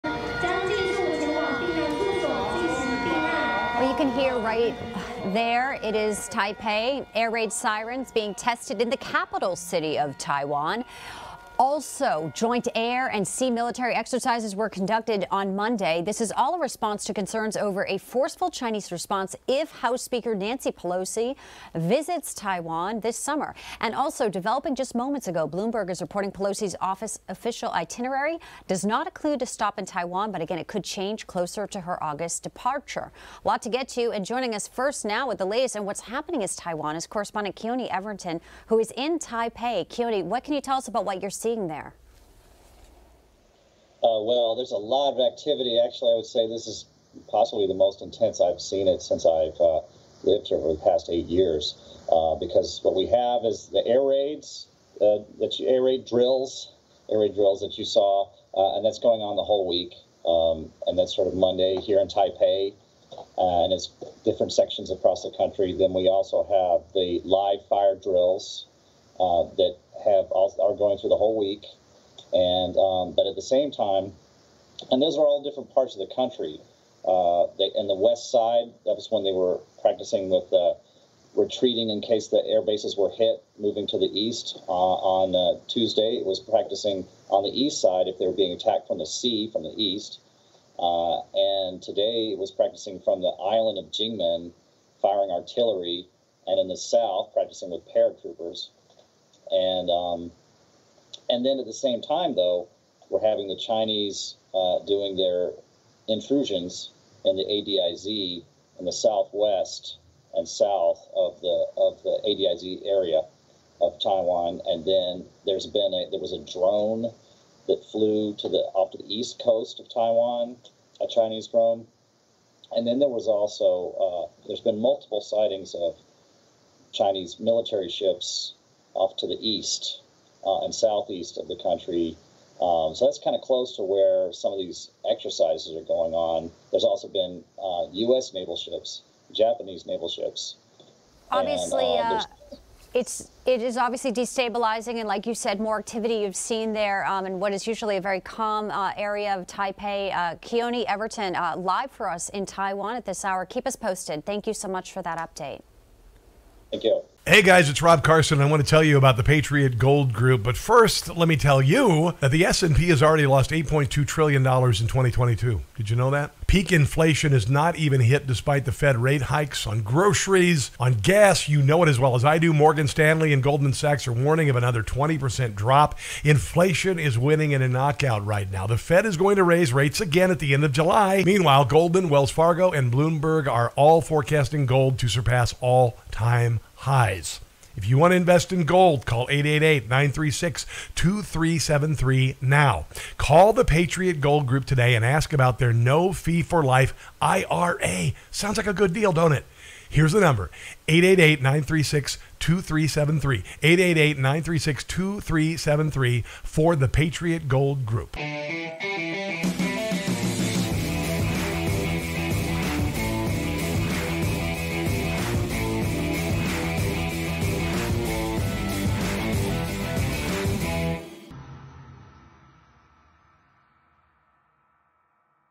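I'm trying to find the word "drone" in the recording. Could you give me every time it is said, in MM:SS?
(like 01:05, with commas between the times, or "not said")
01:56, 02:01.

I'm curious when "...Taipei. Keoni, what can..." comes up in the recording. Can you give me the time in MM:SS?
00:39.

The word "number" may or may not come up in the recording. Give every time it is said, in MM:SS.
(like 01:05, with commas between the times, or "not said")
03:20.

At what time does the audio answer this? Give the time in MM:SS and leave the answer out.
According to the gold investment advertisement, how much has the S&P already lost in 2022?
02:43.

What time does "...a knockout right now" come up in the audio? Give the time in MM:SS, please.
02:57.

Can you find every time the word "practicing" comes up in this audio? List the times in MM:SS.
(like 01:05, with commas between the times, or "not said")
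01:19, 01:26, 01:32, 01:37.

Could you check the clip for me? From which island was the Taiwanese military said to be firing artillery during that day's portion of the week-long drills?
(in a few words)
Jinmen.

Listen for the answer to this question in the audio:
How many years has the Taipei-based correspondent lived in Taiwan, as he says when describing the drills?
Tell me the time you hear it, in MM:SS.
00:51.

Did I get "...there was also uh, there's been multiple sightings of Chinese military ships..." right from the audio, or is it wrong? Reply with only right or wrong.
right.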